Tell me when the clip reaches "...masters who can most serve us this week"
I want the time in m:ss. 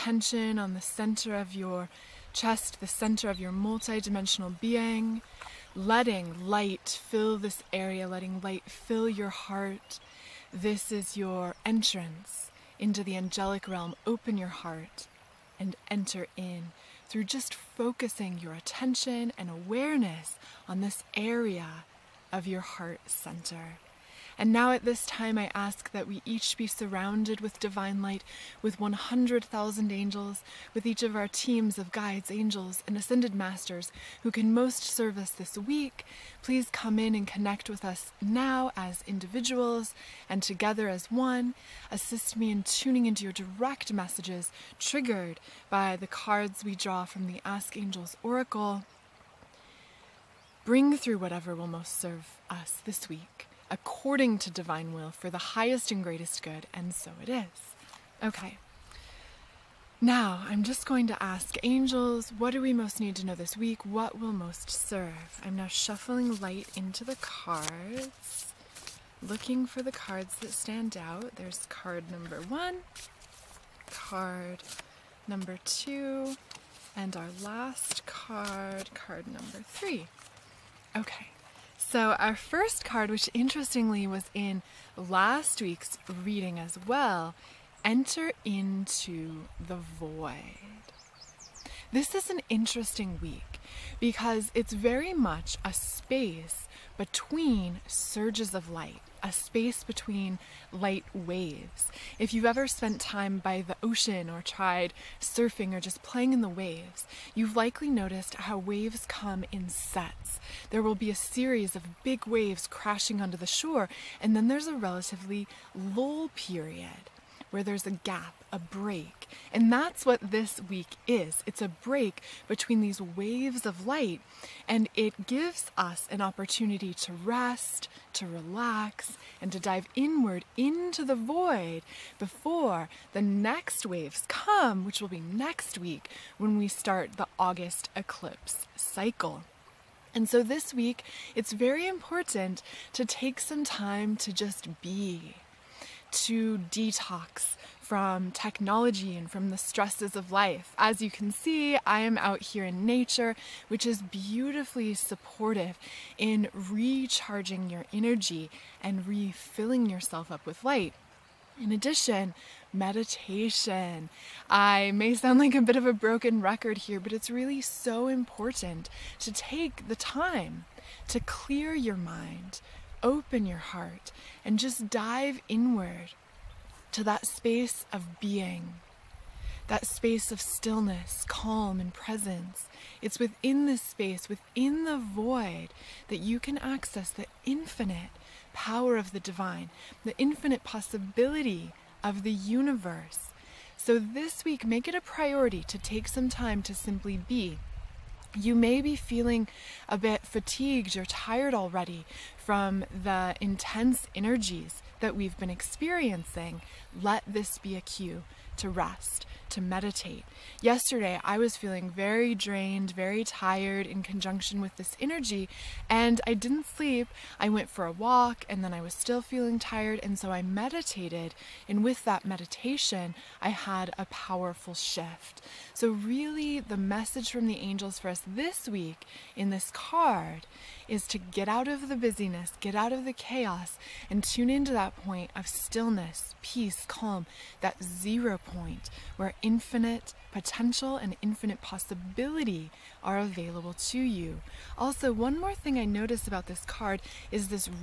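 0:33.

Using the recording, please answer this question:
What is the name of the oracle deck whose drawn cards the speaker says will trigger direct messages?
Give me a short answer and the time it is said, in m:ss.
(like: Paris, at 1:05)
Ask Angels Oracle, at 0:47.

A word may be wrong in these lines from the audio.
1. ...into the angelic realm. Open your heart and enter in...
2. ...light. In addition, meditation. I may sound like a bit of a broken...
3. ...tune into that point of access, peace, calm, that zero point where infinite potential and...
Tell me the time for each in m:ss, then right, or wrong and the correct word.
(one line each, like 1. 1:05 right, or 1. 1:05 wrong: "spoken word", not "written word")
1. 0:12 right
2. 2:40 right
3. 3:54 wrong: "stillness", not "access".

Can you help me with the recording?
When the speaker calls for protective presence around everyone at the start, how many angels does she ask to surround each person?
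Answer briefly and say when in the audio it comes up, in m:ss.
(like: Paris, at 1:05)
100,000, at 0:28.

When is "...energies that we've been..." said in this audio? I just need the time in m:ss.
3:24.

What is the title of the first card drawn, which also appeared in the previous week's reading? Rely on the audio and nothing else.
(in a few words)
Enter into the void.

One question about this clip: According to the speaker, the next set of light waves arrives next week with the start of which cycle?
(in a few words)
August eclipse cycle.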